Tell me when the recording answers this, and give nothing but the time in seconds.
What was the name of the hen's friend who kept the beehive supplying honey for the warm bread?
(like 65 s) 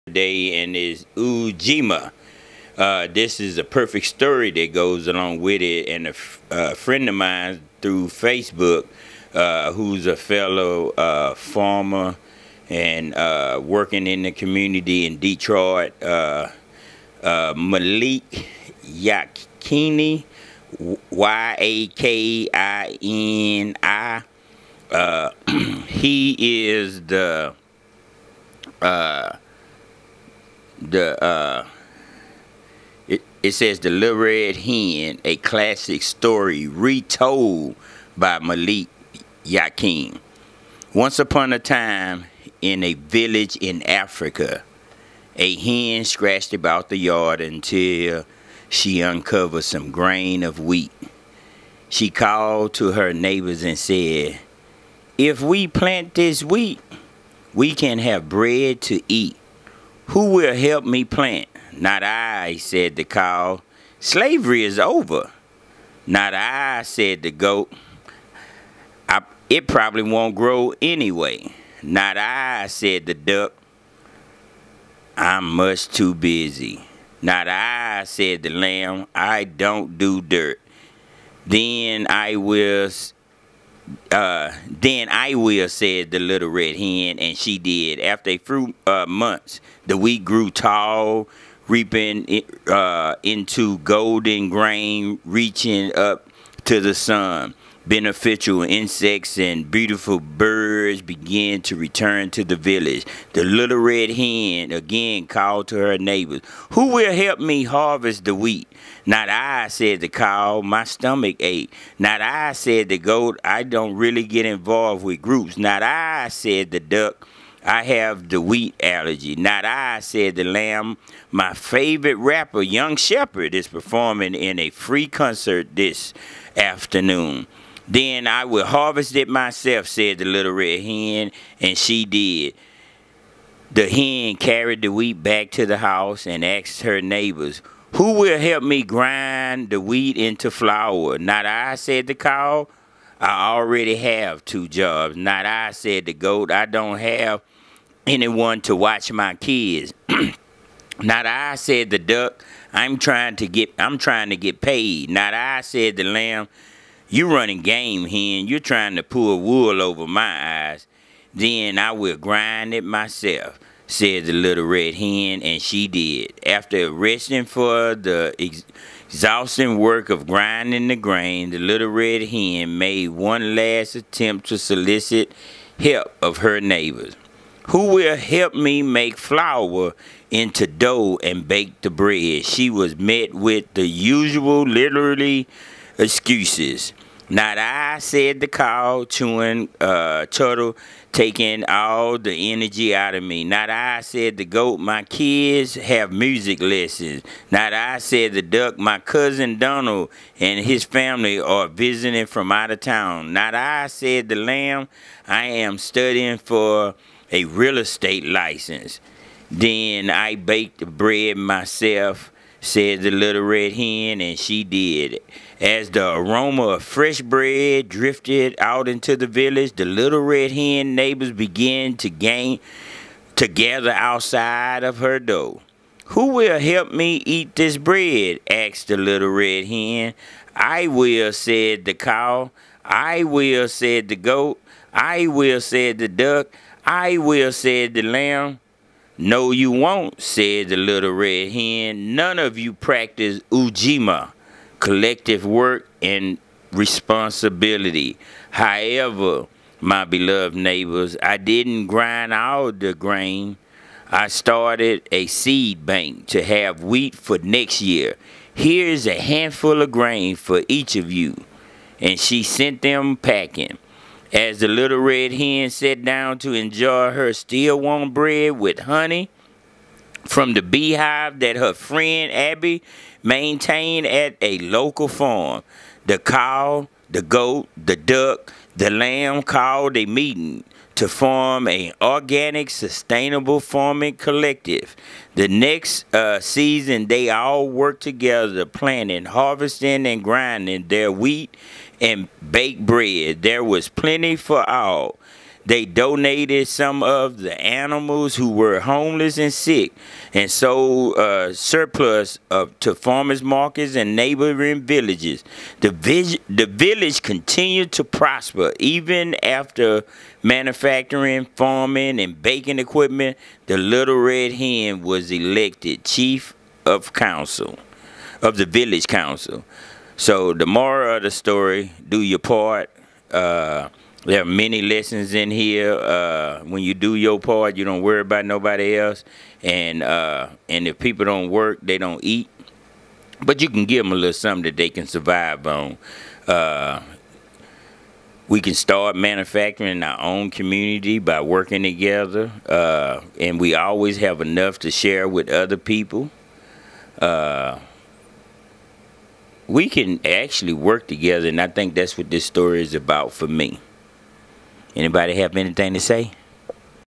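272 s.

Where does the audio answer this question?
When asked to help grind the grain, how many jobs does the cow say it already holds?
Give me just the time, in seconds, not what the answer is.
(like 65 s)
144 s.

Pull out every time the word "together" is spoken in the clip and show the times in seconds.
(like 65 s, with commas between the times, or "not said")
288 s, 341 s, 351 s.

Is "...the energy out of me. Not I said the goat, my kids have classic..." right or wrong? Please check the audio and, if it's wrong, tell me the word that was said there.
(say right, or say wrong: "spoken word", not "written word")
wrong: "music", not "classic".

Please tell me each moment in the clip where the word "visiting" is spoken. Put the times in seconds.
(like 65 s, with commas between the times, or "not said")
201 s.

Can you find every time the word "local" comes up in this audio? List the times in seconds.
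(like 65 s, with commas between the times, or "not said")
274 s.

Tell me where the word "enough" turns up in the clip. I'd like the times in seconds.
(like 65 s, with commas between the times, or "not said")
344 s.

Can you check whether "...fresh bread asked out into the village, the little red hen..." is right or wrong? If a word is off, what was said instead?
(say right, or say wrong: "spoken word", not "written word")
wrong: "drifted", not "asked".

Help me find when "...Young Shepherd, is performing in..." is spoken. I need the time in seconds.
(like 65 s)
122 s.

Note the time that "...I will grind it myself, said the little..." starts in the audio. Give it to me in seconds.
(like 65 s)
161 s.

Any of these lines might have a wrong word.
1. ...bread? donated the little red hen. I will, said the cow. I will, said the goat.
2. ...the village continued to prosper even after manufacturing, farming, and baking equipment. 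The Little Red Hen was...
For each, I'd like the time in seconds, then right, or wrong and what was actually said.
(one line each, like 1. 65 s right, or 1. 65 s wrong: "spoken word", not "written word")
1. 227 s wrong: "asked", not "donated"
2. 306 s right.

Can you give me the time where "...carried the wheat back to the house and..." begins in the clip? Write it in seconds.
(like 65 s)
134 s.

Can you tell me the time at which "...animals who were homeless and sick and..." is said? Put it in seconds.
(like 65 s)
297 s.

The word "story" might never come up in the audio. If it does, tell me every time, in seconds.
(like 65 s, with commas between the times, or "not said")
4 s, 36 s, 321 s, 352 s.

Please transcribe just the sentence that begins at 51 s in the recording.
She called to her neighbors and said, If we plant this wheat, we can have bread to eat.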